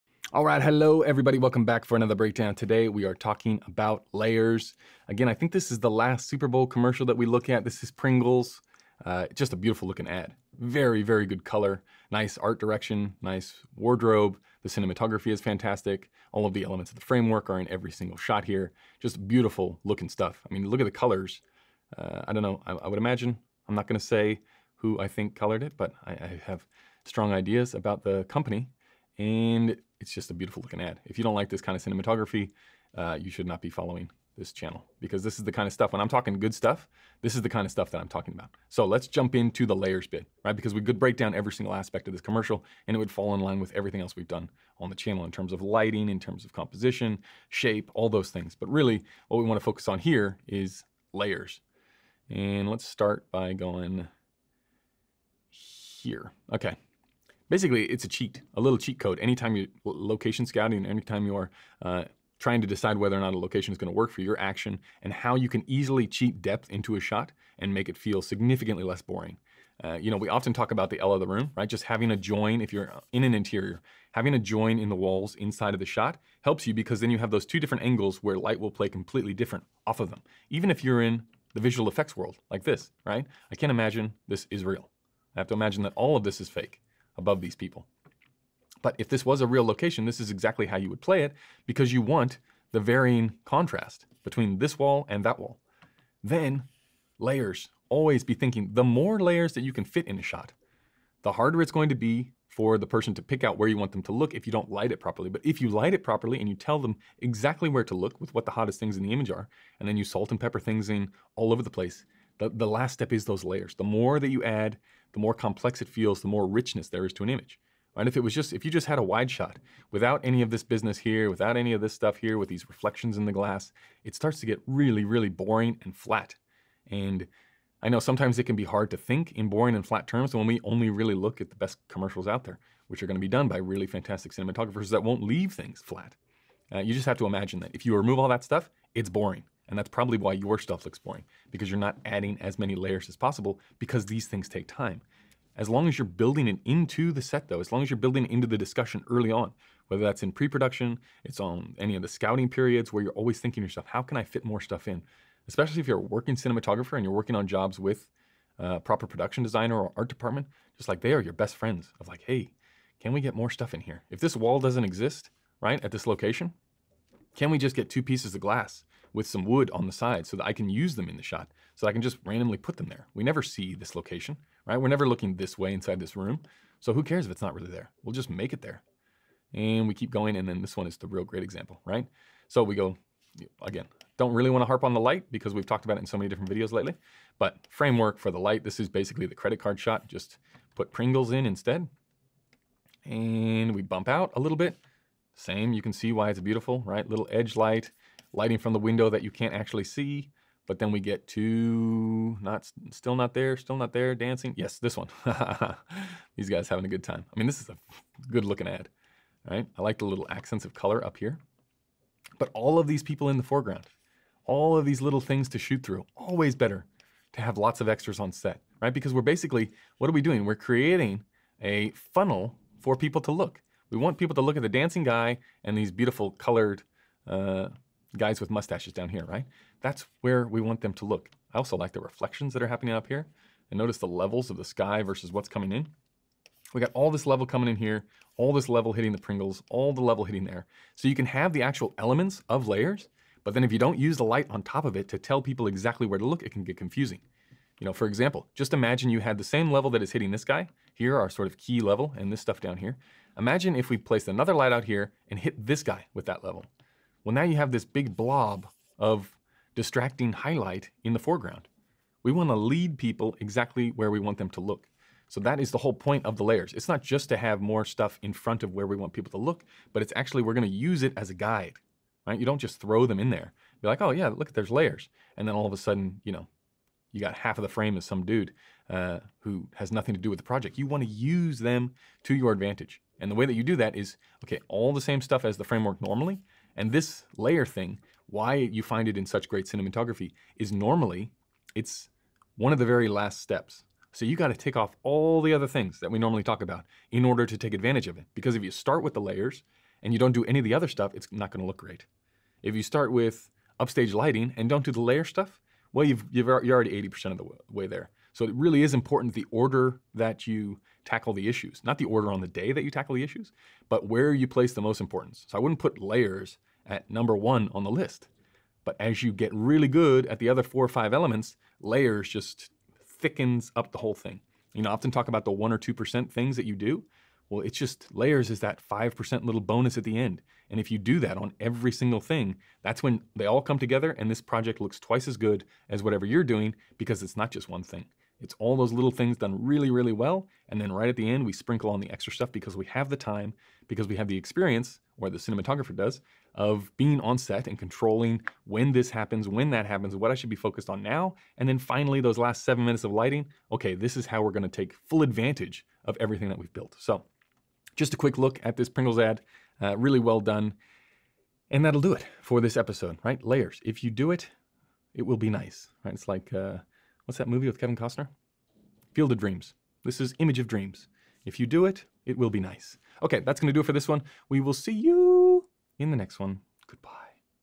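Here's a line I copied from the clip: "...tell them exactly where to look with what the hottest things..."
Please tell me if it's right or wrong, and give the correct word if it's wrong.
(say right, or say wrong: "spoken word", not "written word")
right.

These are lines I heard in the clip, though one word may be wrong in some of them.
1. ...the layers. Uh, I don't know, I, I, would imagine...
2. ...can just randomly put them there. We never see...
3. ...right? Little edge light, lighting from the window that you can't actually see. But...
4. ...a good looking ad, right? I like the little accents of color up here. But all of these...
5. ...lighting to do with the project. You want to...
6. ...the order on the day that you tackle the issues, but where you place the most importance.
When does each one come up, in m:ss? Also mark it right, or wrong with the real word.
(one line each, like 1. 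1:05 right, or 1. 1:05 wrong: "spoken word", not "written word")
1. 0:20 wrong: "colors", not "layers"
2. 2:51 right
3. 3:16 right
4. 3:27 right
5. 4:39 wrong: "nothing", not "lighting"
6. 5:11 right.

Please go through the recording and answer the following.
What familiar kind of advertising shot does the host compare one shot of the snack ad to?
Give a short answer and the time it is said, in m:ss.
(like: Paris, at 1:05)
the credit card shot, at 3:09.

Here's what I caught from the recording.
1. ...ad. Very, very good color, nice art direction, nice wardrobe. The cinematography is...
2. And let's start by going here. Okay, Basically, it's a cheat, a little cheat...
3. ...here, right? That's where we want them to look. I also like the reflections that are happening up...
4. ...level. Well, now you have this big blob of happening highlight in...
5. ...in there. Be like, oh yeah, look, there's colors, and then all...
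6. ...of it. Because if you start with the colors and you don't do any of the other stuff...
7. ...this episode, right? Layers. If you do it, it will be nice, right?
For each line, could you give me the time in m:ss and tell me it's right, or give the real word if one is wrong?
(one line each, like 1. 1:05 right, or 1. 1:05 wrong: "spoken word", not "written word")
1. 0:10 right
2. 0:52 right
3. 3:49 right
4. 4:16 wrong: "distracting", not "happening"
5. 4:33 wrong: "layers", not "colors"
6. 4:58 wrong: "layers", not "colors"
7. 6:02 right.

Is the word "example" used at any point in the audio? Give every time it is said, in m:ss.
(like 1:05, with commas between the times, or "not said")
3:01, 4:08.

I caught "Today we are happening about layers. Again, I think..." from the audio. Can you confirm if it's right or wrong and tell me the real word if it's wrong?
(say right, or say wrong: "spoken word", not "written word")
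wrong: "talking", not "happening".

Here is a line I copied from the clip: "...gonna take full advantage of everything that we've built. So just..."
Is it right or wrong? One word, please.
right.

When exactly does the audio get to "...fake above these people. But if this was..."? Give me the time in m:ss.
1:26.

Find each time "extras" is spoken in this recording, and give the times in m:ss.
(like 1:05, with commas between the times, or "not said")
3:37, 5:42.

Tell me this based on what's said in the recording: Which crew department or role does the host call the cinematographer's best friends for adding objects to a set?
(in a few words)
production designer or art department.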